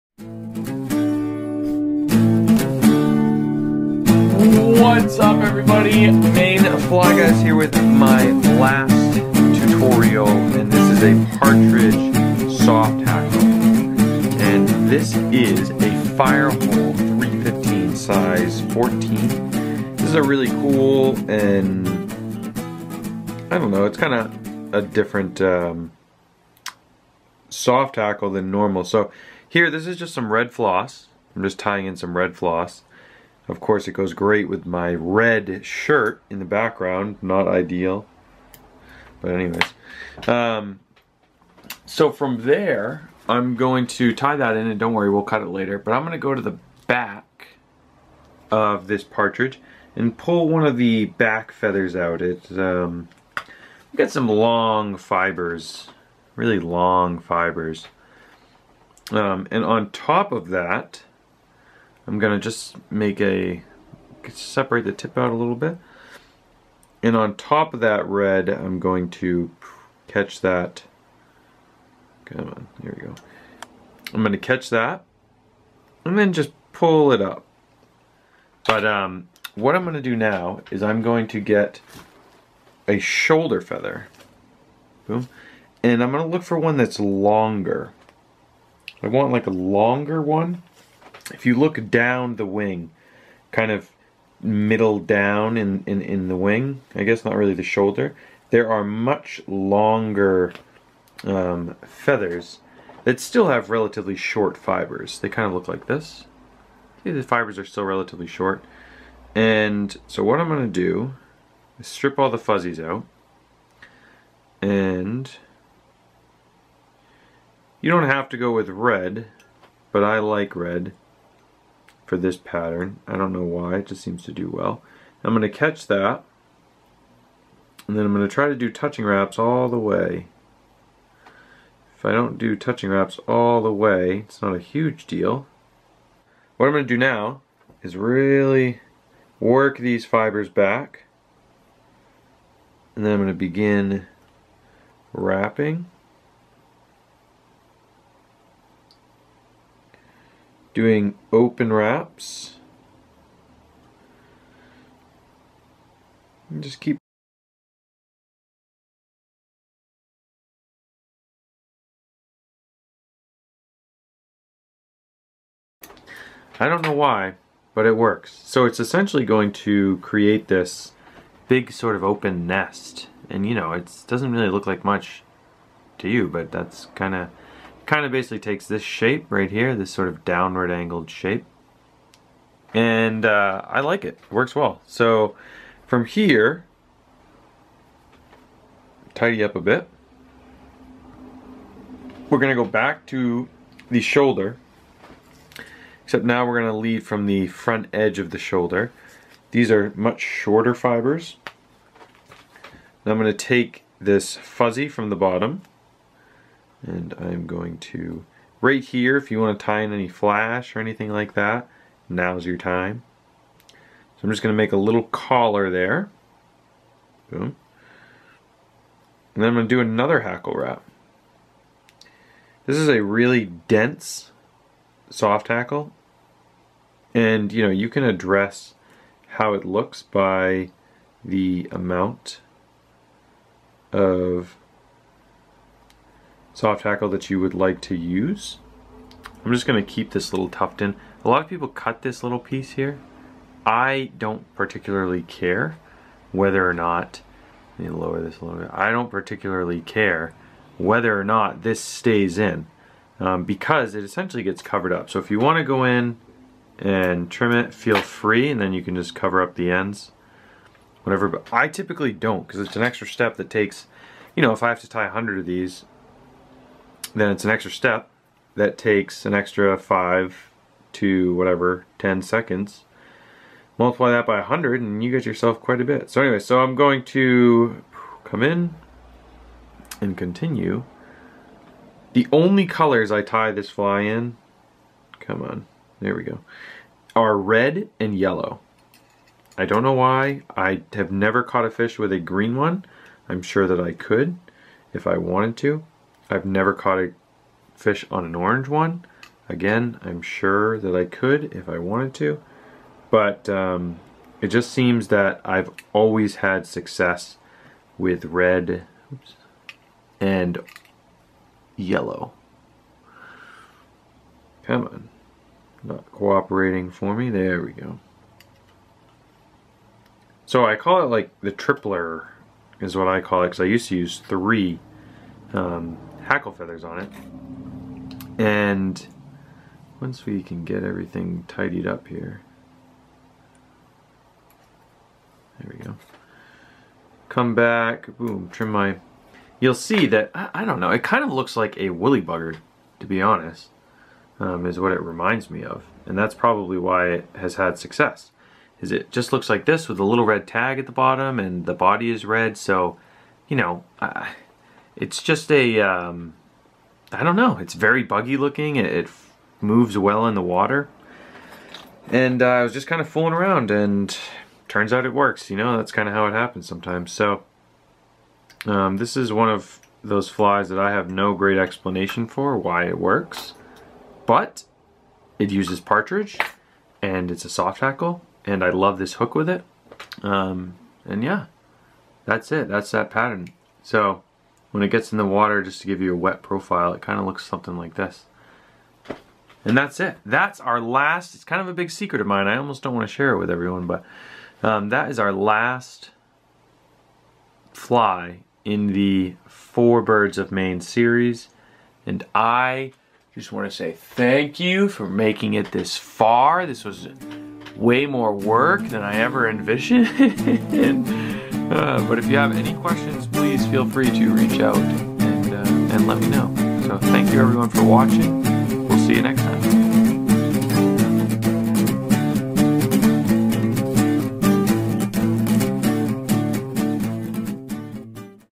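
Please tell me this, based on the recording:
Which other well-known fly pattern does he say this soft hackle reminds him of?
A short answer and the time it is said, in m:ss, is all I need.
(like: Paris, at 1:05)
woolly bugger, at 5:41.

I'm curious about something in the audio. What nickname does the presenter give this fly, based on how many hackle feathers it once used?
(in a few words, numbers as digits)
the tripler.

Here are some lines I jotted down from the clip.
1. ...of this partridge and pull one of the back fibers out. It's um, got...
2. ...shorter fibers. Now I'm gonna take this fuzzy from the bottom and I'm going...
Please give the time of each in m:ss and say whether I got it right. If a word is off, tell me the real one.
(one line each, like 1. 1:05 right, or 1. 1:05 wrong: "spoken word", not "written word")
1. 0:48 wrong: "feathers", not "fibers"
2. 3:20 right.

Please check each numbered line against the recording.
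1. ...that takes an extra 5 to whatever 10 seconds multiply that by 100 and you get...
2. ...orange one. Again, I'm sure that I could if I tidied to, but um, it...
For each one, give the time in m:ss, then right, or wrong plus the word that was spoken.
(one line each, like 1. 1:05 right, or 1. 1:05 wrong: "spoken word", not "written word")
1. 4:28 right
2. 4:58 wrong: "wanted", not "tidied".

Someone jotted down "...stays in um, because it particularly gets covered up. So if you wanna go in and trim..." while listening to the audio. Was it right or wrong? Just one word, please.
wrong.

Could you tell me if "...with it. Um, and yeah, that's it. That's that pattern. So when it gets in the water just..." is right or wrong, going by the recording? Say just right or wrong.
right.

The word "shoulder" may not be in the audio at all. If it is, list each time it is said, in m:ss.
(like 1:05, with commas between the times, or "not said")
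1:22, 1:37, 3:13, 3:18.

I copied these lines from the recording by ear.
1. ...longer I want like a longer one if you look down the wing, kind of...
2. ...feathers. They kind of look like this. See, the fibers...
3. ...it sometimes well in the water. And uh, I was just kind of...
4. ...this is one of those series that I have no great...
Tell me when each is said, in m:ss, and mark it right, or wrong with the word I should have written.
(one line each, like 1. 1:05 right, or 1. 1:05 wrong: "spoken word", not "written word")
1. 1:26 right
2. 1:44 wrong: "fibers", not "feathers"
3. 5:58 wrong: "moves", not "sometimes"
4. 6:08 wrong: "flies", not "series".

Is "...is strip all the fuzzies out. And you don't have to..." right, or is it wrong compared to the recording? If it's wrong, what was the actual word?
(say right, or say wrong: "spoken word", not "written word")
right.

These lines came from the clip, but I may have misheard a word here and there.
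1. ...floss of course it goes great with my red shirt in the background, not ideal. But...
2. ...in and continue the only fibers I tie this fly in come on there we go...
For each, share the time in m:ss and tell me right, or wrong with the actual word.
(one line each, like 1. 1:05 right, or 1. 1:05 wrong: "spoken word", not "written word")
1. 0:32 right
2. 4:38 wrong: "colors", not "fibers".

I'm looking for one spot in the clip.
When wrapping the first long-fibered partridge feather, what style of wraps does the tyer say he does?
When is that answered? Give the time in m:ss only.
2:31.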